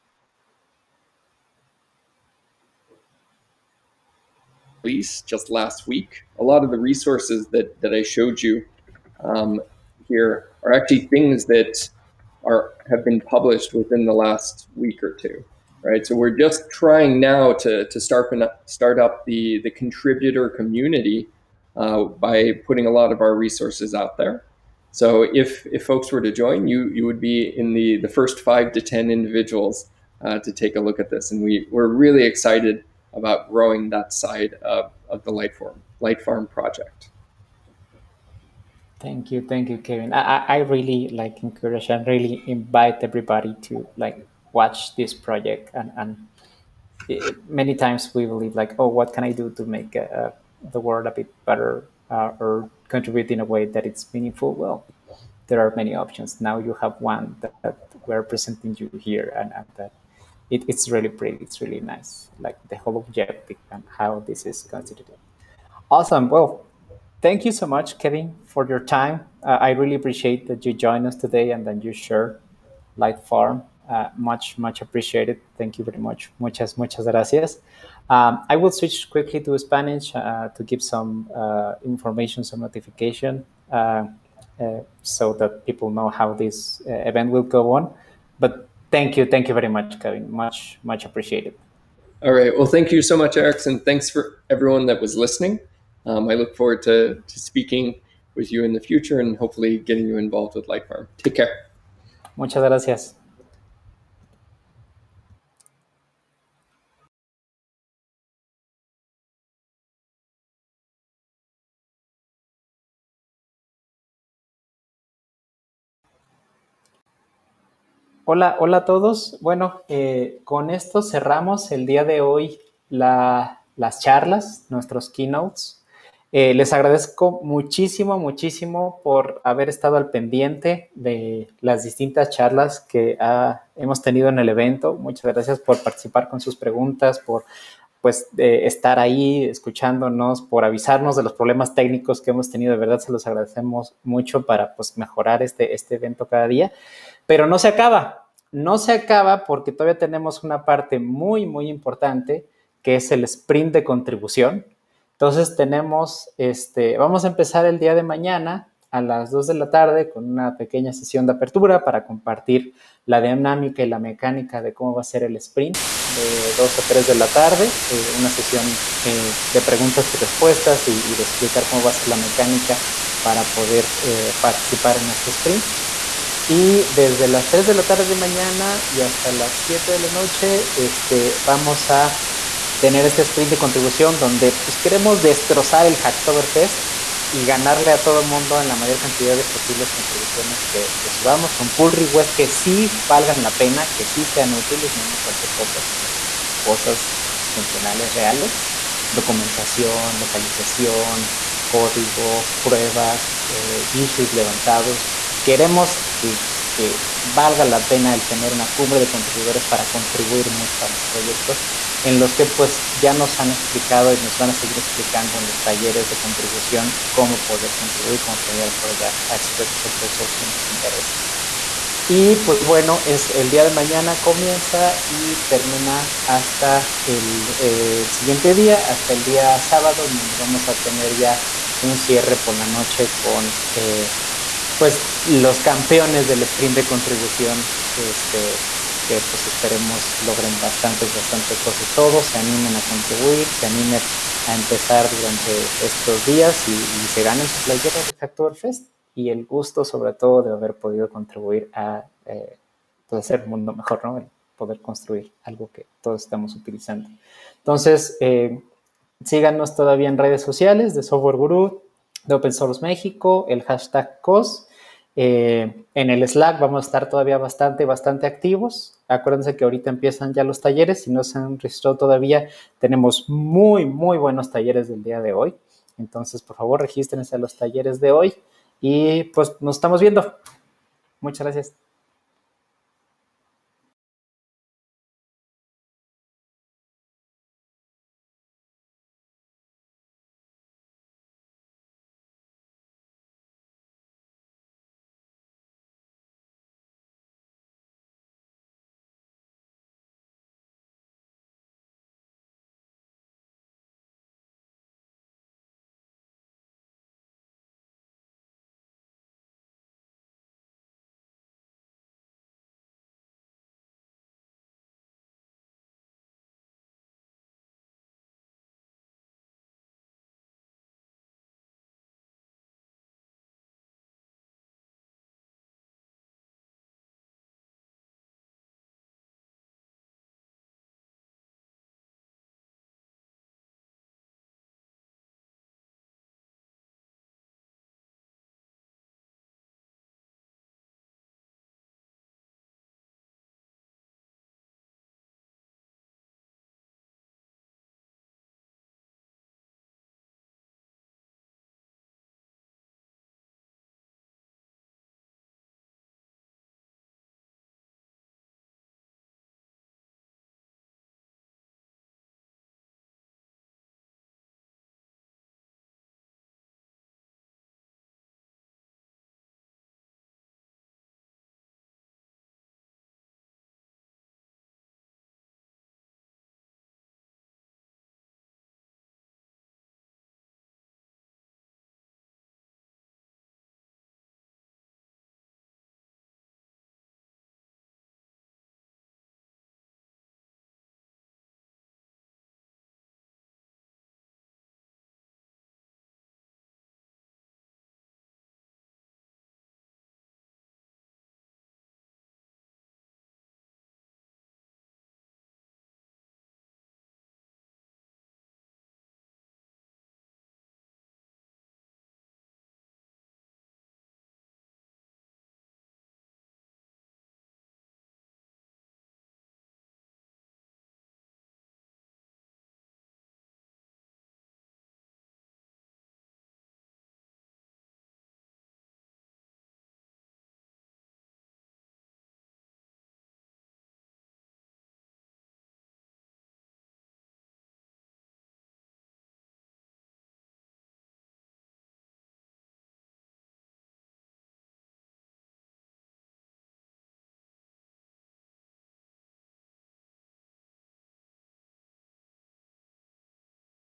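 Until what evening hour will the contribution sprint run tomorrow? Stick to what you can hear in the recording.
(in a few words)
7 p.m.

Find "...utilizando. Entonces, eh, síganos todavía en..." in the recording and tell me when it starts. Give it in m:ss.
4:16.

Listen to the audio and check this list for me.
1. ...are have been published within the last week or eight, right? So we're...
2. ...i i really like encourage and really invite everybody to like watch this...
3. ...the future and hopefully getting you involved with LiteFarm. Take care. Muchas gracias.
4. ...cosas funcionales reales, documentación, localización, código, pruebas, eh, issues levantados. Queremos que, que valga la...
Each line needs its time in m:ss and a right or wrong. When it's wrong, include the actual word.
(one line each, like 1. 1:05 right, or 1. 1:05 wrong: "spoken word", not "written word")
1. 0:12 wrong: "two", not "eight"
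2. 0:40 right
3. 1:38 right
4. 3:16 right.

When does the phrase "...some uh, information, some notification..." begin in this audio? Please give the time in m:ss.
1:20.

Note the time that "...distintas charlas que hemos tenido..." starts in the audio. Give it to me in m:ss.
2:11.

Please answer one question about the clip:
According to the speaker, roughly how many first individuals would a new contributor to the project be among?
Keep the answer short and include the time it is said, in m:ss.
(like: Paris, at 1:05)
5 to 10, at 0:28.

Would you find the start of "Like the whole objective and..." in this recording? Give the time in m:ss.
1:02.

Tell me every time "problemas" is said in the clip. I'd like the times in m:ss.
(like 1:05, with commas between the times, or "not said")
2:21.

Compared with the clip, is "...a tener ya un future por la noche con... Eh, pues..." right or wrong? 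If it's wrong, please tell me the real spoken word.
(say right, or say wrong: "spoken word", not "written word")
wrong: "cierre", not "future".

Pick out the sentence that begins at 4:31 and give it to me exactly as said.
Si no se han registrado todavía, tenemos muy, muy buenos talleres del día de hoy.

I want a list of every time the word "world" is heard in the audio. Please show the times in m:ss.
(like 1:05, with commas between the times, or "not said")
0:50.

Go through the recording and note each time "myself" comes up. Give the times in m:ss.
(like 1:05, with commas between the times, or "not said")
not said.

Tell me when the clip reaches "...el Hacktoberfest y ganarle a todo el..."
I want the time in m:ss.
3:05.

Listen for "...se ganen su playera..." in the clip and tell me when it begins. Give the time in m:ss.
4:07.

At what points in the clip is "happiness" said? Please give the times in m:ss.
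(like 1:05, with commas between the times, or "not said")
not said.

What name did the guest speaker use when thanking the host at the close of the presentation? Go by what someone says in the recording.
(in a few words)
Erickson.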